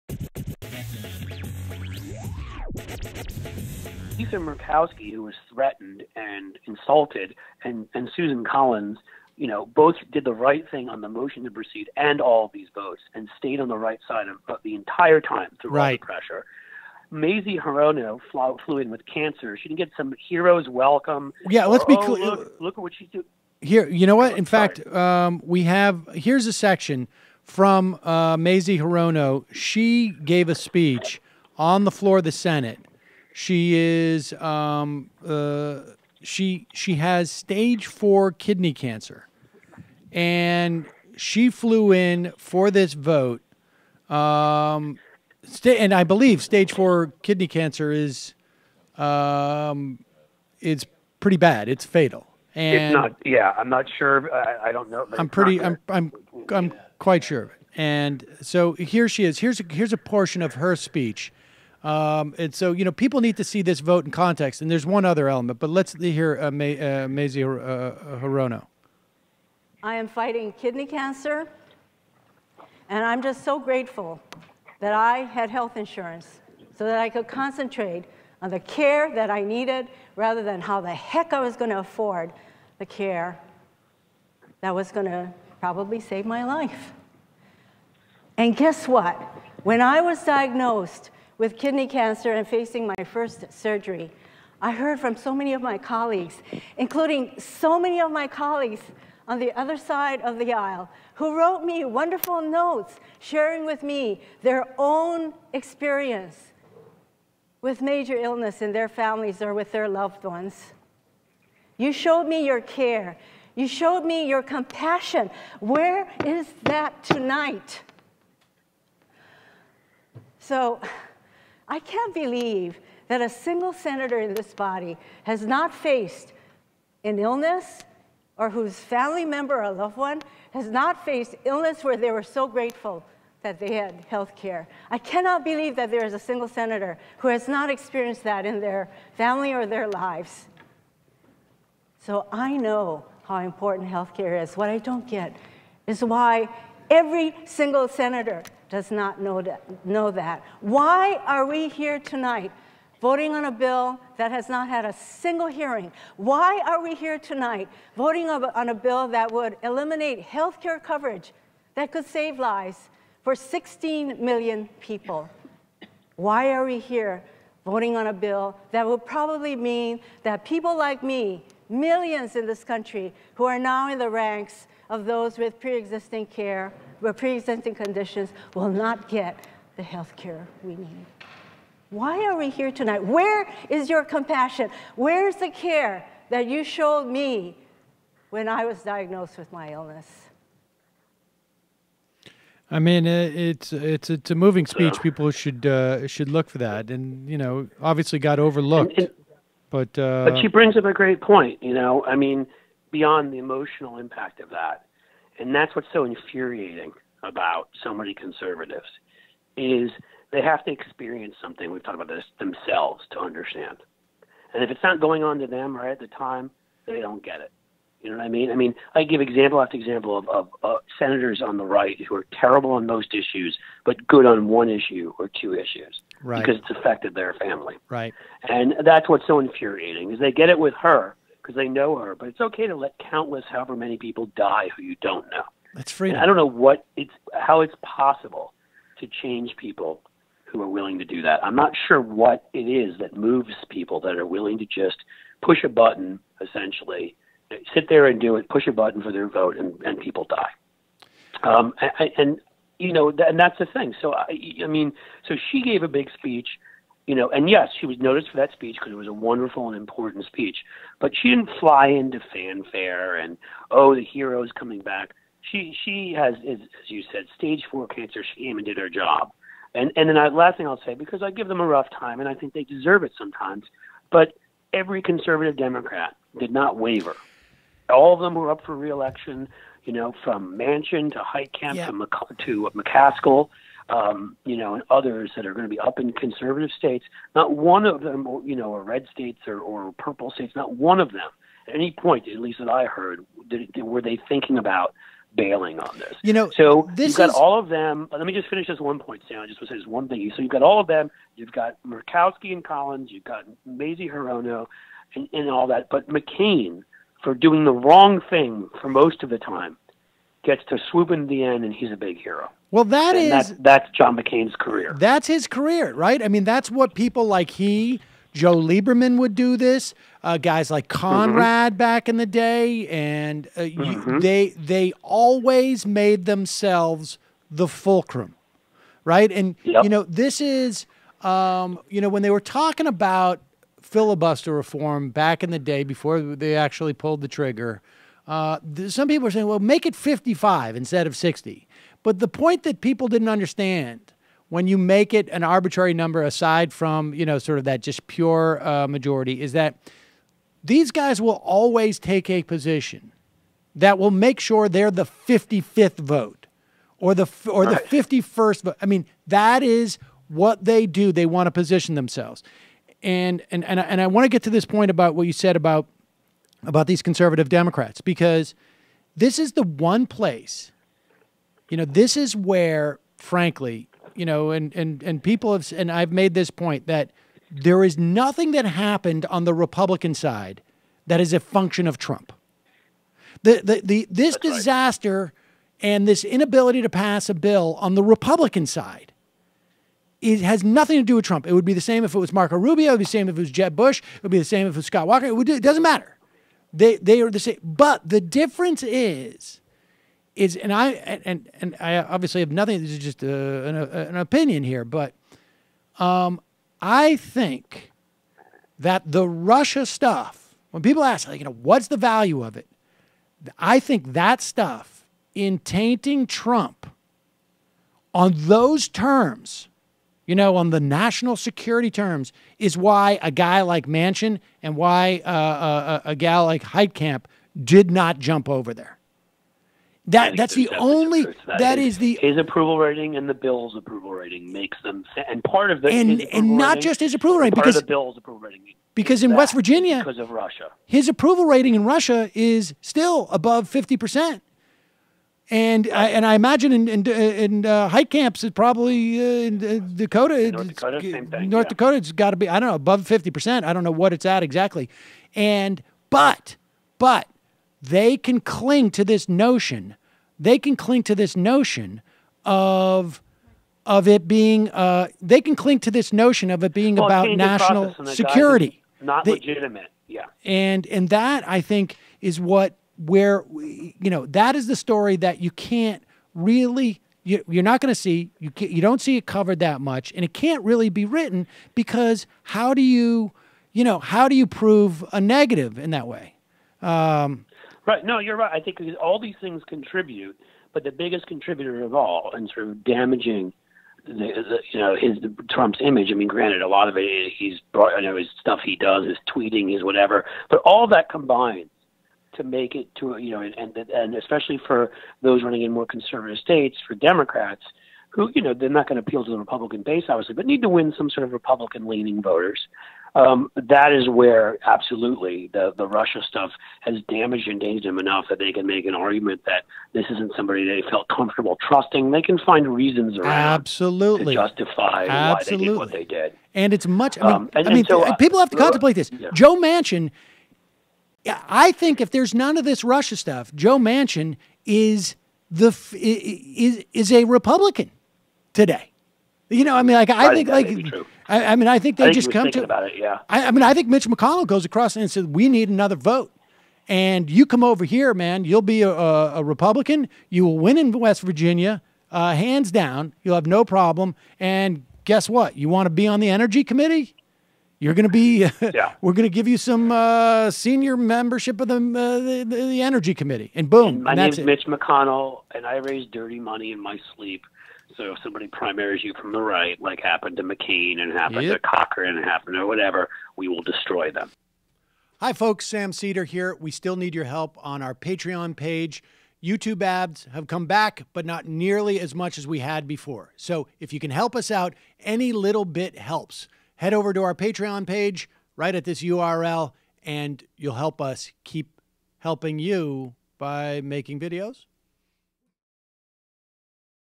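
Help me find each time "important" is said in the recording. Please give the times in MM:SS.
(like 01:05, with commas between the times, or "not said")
02:23, 04:19.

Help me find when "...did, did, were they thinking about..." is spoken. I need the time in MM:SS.
04:53.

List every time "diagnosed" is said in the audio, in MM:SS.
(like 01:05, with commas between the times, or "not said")
01:30, 03:08.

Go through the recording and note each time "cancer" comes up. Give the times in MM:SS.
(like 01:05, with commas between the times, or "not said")
00:19, 00:38, 00:47, 01:10, 01:31, 04:27.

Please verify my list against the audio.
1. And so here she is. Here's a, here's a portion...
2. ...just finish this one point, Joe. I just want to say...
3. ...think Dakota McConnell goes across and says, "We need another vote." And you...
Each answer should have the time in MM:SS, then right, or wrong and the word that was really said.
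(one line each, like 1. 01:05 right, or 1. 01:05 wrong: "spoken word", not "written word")
1. 00:57 right
2. 04:58 wrong: "Sam", not "Joe"
3. 09:03 wrong: "Mitch", not "Dakota".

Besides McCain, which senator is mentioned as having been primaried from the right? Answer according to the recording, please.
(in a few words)
Cochran.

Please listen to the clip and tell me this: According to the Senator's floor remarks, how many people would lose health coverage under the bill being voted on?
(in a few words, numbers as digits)
16 million.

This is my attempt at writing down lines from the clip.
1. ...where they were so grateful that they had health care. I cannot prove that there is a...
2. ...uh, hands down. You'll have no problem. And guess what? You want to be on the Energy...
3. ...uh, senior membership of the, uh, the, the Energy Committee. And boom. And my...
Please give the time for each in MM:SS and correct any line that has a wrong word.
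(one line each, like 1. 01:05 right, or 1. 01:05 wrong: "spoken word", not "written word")
1. 02:11 wrong: "believe", not "prove"
2. 09:12 right
3. 09:19 right.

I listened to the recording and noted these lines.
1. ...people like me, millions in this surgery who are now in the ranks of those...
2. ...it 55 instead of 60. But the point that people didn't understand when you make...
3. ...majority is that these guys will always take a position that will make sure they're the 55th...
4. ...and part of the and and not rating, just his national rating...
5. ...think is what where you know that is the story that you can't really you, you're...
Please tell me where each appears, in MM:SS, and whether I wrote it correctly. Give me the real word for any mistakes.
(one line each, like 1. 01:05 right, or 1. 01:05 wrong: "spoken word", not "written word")
1. 02:50 wrong: "country", not "surgery"
2. 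05:39 right
3. 05:48 right
4. 07:15 wrong: "approval", not "national"
5. 07:51 right.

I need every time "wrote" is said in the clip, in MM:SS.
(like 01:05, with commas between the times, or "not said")
01:41.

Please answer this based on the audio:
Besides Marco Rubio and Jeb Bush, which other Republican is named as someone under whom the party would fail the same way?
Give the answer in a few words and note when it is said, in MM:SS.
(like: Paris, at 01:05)
Scott Walker, at 06:34.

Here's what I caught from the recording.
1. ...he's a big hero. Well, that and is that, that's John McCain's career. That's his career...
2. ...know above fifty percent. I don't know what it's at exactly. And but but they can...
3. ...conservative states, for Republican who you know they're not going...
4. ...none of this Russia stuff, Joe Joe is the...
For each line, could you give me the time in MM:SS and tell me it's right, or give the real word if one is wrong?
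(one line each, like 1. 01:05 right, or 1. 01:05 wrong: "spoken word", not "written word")
1. 05:11 right
2. 07:32 right
3. 08:25 wrong: "Democrats", not "Republican"
4. 08:52 wrong: "Manchin", not "Joe".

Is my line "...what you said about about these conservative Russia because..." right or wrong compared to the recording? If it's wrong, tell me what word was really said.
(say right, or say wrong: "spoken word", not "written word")
wrong: "Democrats", not "Russia".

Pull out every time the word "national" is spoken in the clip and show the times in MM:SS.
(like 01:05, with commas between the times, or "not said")
07:00, 07:47.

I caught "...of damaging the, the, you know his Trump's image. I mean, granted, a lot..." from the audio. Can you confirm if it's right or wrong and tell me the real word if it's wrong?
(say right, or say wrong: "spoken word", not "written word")
right.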